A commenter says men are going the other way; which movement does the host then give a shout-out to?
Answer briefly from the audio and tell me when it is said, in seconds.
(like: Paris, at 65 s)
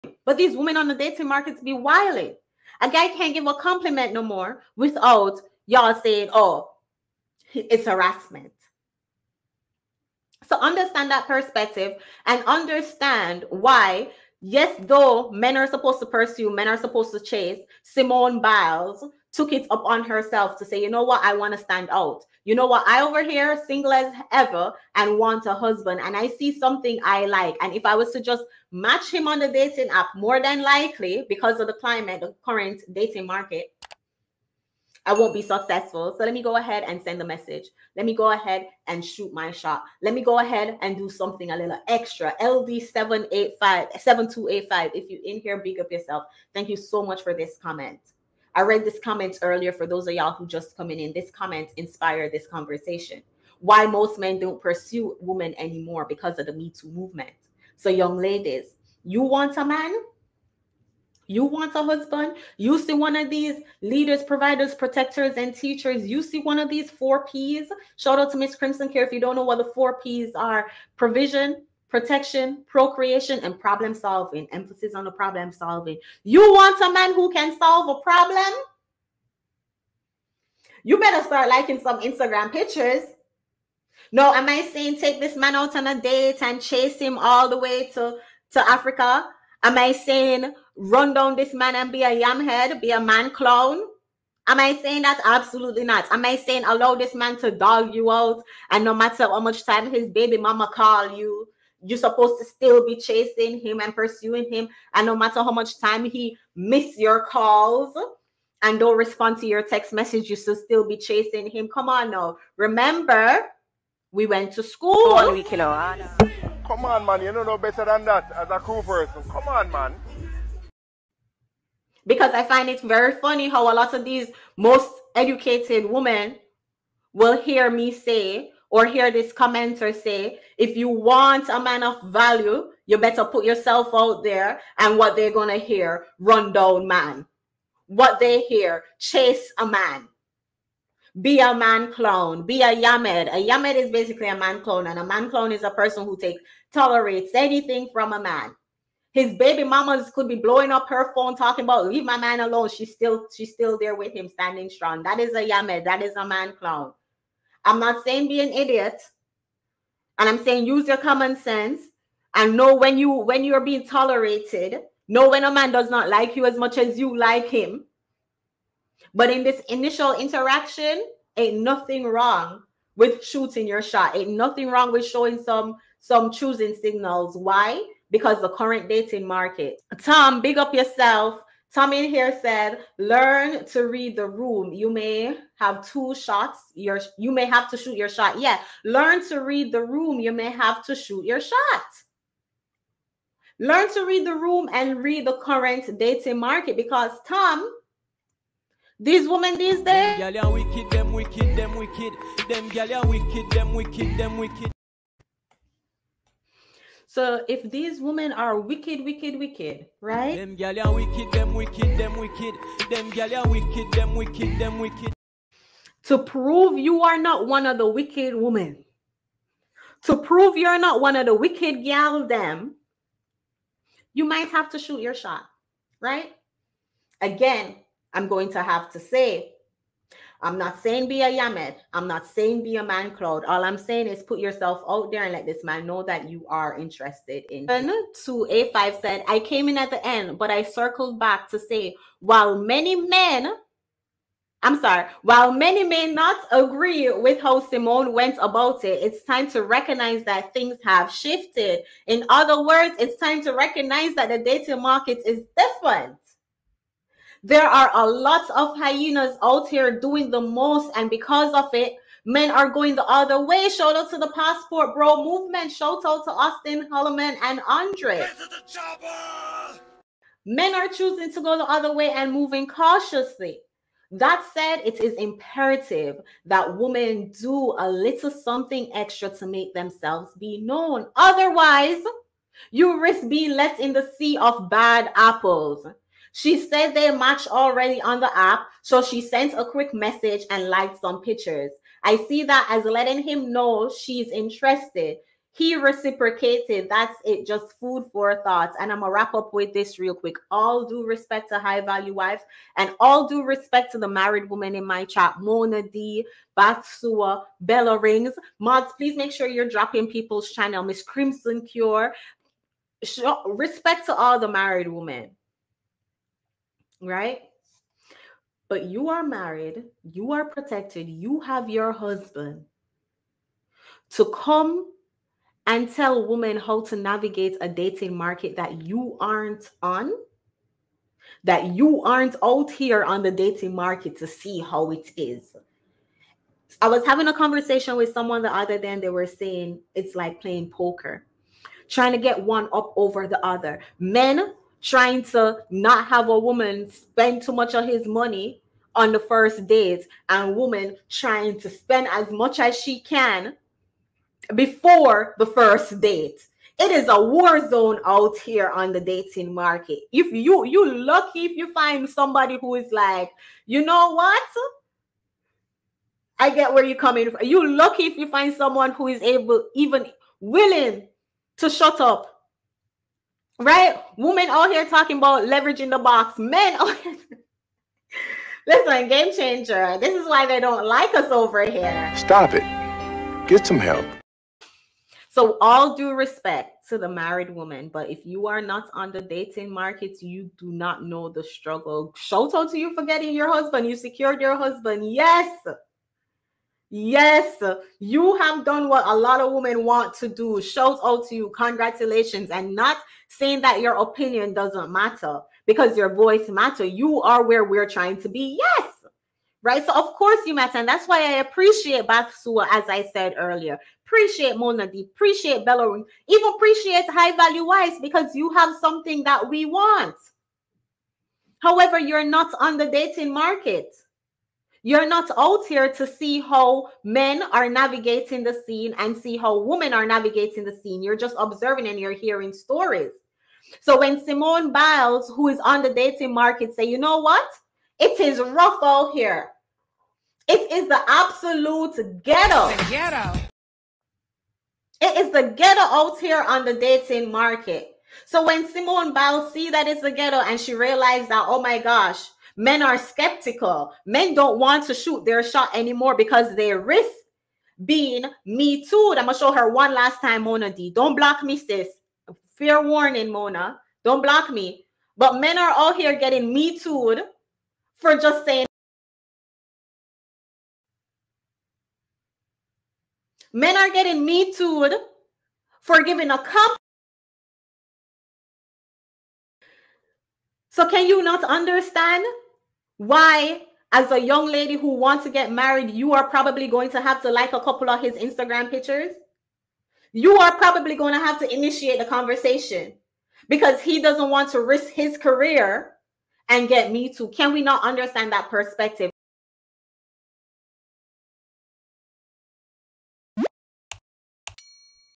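Passport Bro movement, at 264 s.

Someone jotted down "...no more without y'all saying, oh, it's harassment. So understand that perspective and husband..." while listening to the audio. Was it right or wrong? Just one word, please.
wrong.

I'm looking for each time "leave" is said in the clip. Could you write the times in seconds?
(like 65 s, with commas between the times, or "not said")
151 s.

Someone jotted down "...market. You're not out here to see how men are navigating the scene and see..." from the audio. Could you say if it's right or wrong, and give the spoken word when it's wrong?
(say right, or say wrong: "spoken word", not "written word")
right.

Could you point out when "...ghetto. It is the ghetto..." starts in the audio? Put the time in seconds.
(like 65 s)
442 s.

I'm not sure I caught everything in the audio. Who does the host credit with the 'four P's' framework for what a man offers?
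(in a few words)
Miss Crimson Care.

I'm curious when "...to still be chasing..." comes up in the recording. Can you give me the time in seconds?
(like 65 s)
102 s.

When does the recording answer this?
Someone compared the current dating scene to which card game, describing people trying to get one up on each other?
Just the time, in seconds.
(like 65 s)
340 s.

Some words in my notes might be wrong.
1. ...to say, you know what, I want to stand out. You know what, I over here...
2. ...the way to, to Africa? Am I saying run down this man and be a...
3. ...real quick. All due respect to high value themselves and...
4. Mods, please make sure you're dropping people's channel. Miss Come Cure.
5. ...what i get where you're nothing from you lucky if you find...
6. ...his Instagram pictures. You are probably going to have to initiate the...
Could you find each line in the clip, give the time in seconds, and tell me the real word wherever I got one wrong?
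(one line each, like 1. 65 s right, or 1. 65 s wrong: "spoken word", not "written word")
1. 20 s right
2. 87 s right
3. 299 s wrong: "wives", not "themselves"
4. 308 s wrong: "Crimson", not "Come"
5. 364 s wrong: "coming", not "nothing"
6. 487 s right.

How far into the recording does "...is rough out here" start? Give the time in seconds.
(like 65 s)
438 s.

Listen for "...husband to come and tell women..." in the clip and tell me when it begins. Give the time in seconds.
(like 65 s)
321 s.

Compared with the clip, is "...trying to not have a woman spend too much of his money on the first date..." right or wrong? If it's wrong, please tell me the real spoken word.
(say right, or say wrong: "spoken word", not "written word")
right.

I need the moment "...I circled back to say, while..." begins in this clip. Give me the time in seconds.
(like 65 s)
240 s.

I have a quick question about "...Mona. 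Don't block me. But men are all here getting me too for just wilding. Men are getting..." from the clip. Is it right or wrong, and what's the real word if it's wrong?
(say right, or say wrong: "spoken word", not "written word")
wrong: "saying", not "wilding".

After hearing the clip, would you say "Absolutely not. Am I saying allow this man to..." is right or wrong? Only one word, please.
right.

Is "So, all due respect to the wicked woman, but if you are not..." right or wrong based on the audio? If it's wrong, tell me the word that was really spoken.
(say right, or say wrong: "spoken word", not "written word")
wrong: "married", not "wicked".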